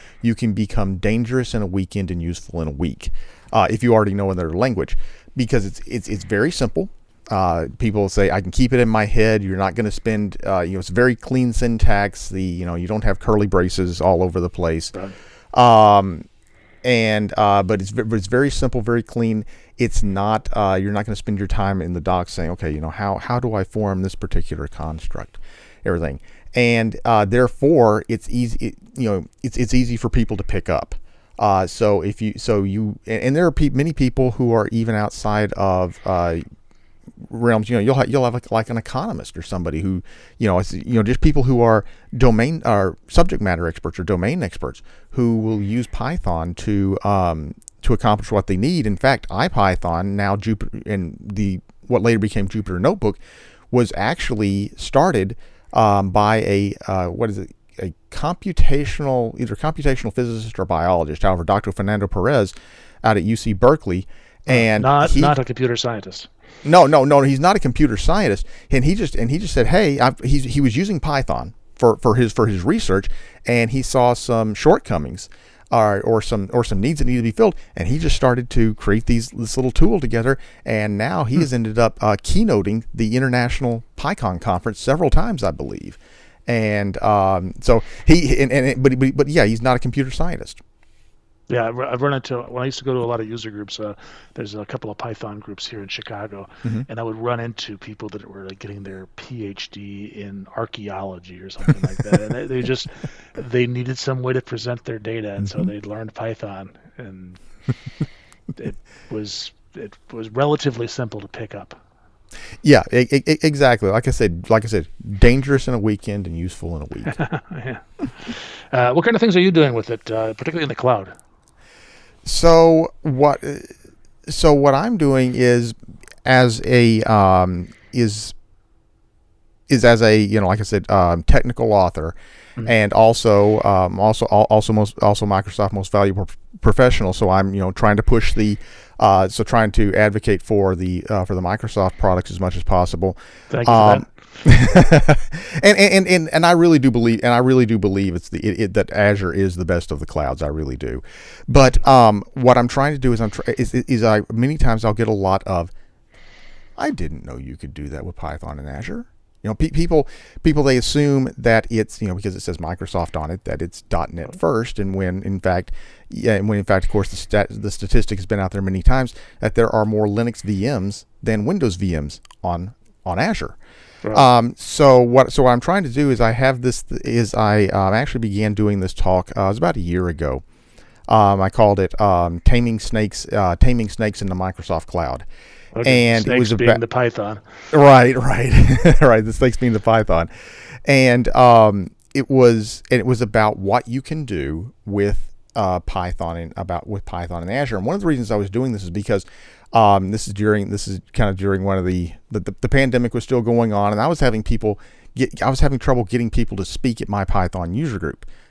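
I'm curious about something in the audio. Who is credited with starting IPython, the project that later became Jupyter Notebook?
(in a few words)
Fernando Perez.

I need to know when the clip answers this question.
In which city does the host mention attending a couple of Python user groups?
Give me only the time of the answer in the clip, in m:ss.
1:35.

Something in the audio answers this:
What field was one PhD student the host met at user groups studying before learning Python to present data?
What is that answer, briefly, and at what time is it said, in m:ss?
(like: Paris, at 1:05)
Archaeology, at 1:40.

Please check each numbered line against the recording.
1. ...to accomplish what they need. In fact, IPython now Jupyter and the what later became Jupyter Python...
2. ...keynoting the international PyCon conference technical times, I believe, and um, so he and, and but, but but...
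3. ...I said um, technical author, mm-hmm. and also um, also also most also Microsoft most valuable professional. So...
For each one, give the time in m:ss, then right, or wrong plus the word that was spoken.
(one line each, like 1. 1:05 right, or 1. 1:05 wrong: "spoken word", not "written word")
1. 0:47 wrong: "Notebook", not "Python"
2. 1:22 wrong: "several", not "technical"
3. 2:10 right.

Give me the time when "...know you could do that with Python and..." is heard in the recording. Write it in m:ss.
2:37.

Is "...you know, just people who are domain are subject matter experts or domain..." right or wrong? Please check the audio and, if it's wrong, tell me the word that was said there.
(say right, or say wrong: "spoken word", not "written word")
right.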